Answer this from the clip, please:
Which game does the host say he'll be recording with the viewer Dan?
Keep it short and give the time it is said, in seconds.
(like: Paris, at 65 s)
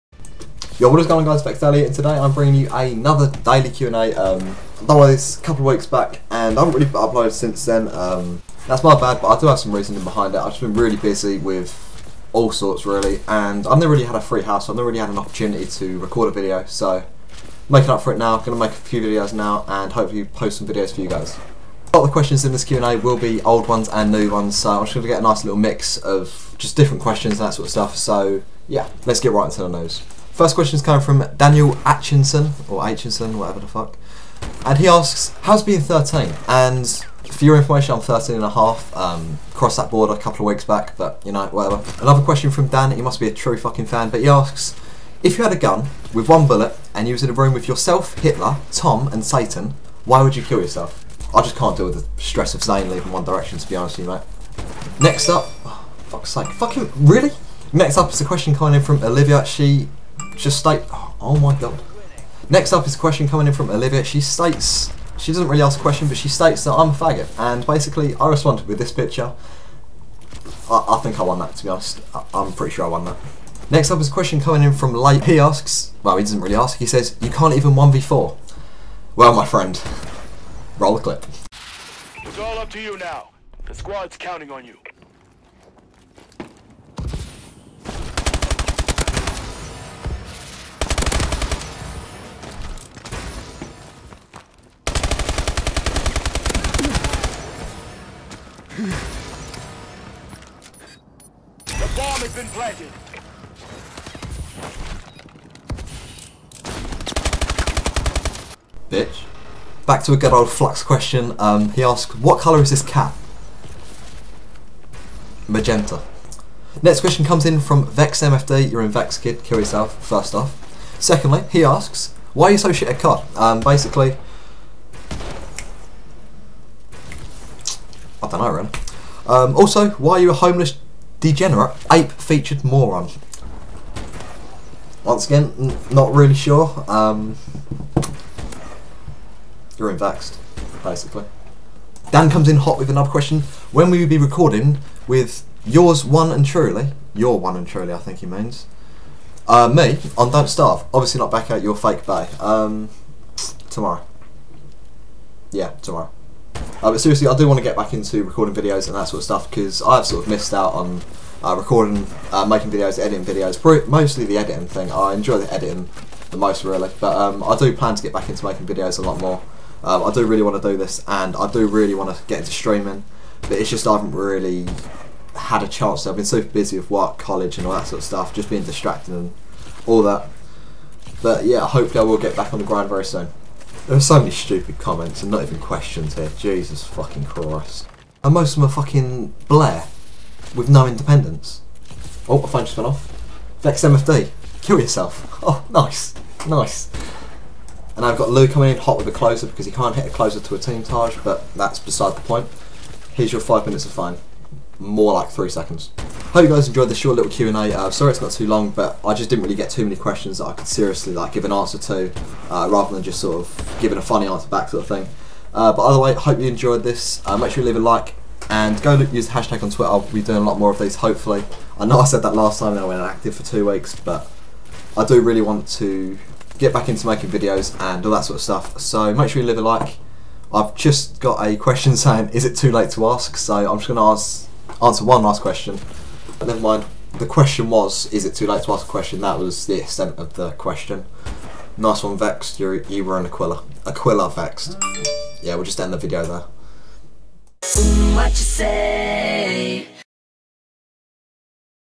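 Don't Starve, at 150 s.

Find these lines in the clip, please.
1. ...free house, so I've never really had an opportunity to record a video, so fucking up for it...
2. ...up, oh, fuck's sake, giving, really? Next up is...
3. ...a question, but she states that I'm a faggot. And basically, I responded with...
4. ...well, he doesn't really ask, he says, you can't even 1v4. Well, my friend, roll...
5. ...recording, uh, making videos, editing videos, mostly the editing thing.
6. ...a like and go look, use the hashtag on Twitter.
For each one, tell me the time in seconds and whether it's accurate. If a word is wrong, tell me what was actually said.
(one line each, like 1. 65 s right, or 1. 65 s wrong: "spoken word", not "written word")
1. 14 s wrong: "making", not "fucking"
2. 55 s wrong: "fucking", not "giving"
3. 65 s right
4. 76 s right
5. 161 s right
6. 217 s right.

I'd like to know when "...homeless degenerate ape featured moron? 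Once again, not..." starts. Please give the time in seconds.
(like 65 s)
130 s.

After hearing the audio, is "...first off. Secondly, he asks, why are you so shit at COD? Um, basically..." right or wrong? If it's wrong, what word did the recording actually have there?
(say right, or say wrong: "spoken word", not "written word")
right.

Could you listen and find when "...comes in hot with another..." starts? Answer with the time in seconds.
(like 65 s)
142 s.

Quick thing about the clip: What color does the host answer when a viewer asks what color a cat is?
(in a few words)
Magenta.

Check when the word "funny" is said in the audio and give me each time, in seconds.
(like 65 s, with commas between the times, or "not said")
214 s.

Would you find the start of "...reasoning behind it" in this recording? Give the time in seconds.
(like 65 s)
9 s.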